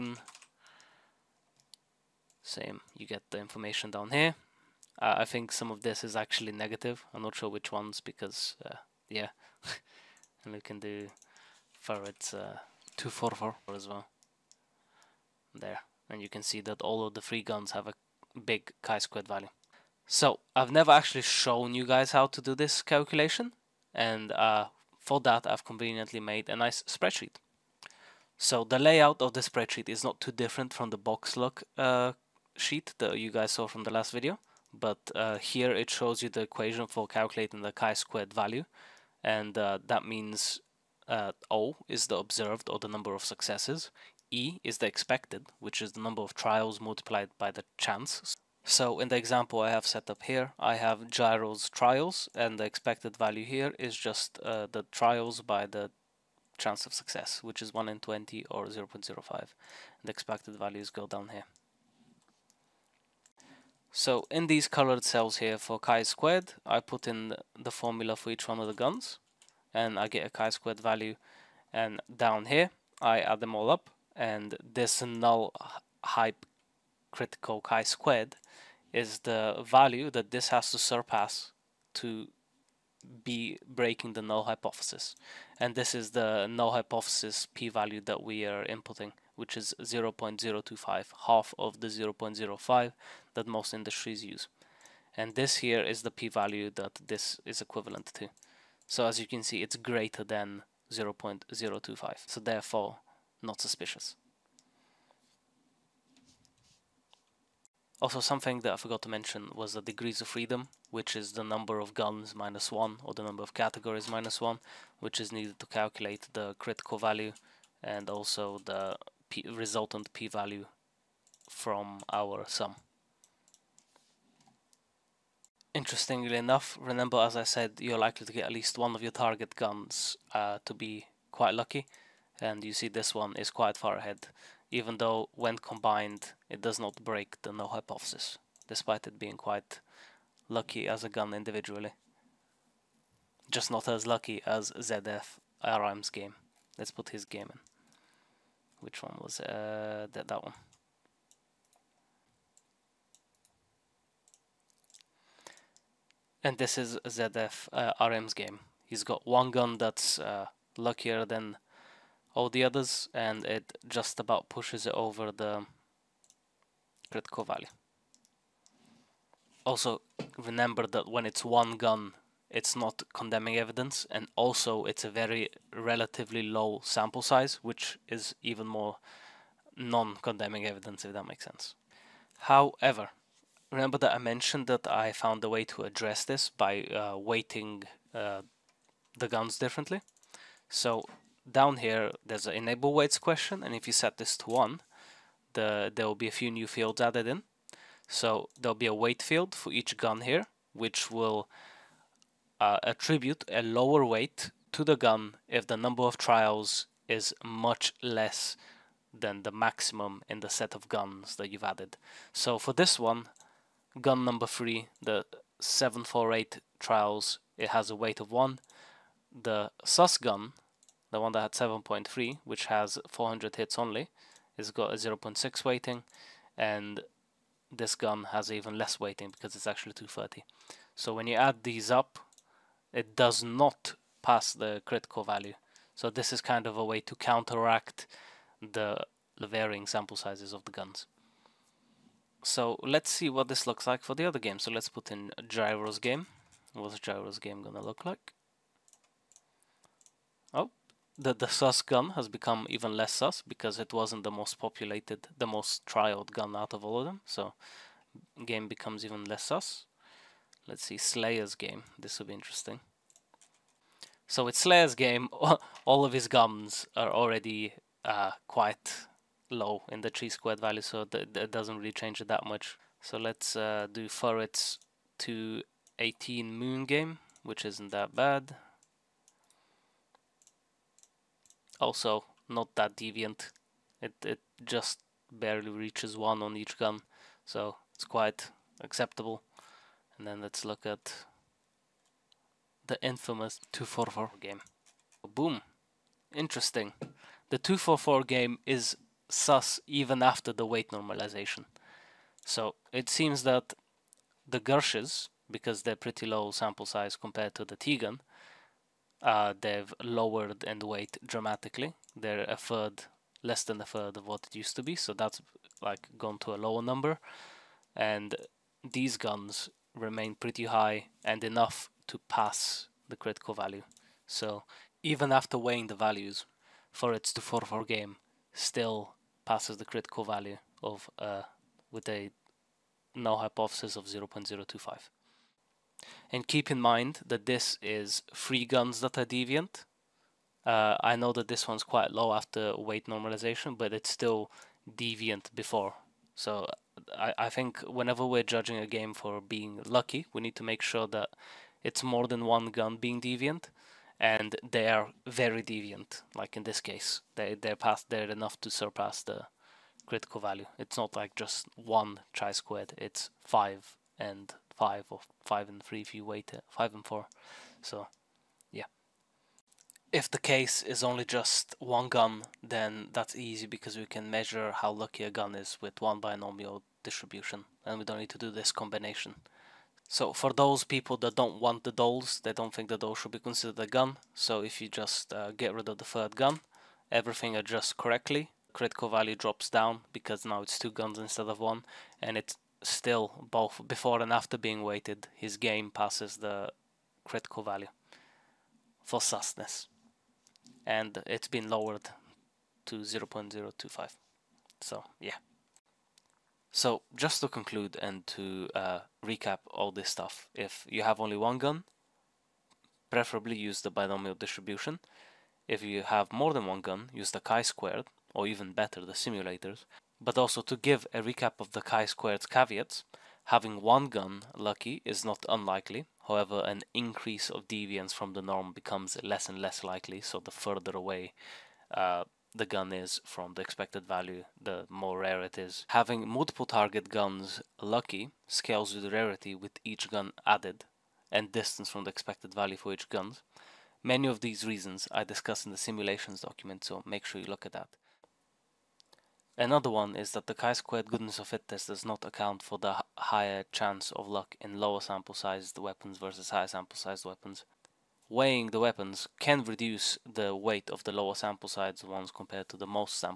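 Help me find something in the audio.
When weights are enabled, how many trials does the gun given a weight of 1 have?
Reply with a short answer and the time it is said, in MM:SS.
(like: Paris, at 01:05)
748, at 03:35.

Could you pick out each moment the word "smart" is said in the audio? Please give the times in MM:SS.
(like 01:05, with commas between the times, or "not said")
not said.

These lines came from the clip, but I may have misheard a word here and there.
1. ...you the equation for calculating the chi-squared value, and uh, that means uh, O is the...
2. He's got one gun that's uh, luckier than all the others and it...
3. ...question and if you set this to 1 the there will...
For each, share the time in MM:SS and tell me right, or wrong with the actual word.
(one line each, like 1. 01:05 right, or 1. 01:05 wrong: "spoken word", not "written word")
1. 00:36 right
2. 02:38 right
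3. 03:13 right.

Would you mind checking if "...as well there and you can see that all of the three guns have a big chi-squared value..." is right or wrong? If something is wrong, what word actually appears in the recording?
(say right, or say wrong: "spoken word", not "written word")
right.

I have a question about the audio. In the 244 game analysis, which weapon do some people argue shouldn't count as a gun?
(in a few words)
the doll.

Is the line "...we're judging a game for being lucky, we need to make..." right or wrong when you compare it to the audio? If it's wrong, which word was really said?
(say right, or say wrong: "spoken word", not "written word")
right.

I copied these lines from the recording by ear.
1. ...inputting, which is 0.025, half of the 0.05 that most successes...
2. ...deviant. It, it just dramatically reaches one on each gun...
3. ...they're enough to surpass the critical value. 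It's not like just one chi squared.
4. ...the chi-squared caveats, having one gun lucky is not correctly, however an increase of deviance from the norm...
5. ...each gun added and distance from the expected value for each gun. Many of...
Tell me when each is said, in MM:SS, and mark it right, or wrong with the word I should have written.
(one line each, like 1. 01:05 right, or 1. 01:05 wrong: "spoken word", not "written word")
1. 01:28 wrong: "industries", not "successes"
2. 04:42 wrong: "barely", not "dramatically"
3. 05:58 right
4. 07:01 wrong: "unlikely", not "correctly"
5. 07:19 right.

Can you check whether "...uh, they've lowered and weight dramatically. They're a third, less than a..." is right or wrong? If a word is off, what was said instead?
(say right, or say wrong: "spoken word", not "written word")
right.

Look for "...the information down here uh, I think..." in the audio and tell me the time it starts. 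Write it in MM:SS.
00:03.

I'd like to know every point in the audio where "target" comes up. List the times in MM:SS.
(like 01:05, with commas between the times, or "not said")
02:09, 07:16.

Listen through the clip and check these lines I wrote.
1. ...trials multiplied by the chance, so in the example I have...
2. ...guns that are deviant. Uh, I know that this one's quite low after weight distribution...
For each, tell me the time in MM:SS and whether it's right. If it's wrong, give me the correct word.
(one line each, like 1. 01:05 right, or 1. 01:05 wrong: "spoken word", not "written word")
1. 00:46 right
2. 05:38 wrong: "normalization", not "distribution".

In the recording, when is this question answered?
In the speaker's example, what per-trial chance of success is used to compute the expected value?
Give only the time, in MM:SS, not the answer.
00:57.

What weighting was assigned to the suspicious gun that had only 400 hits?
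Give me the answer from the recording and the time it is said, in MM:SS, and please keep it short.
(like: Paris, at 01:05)
0.6, at 03:44.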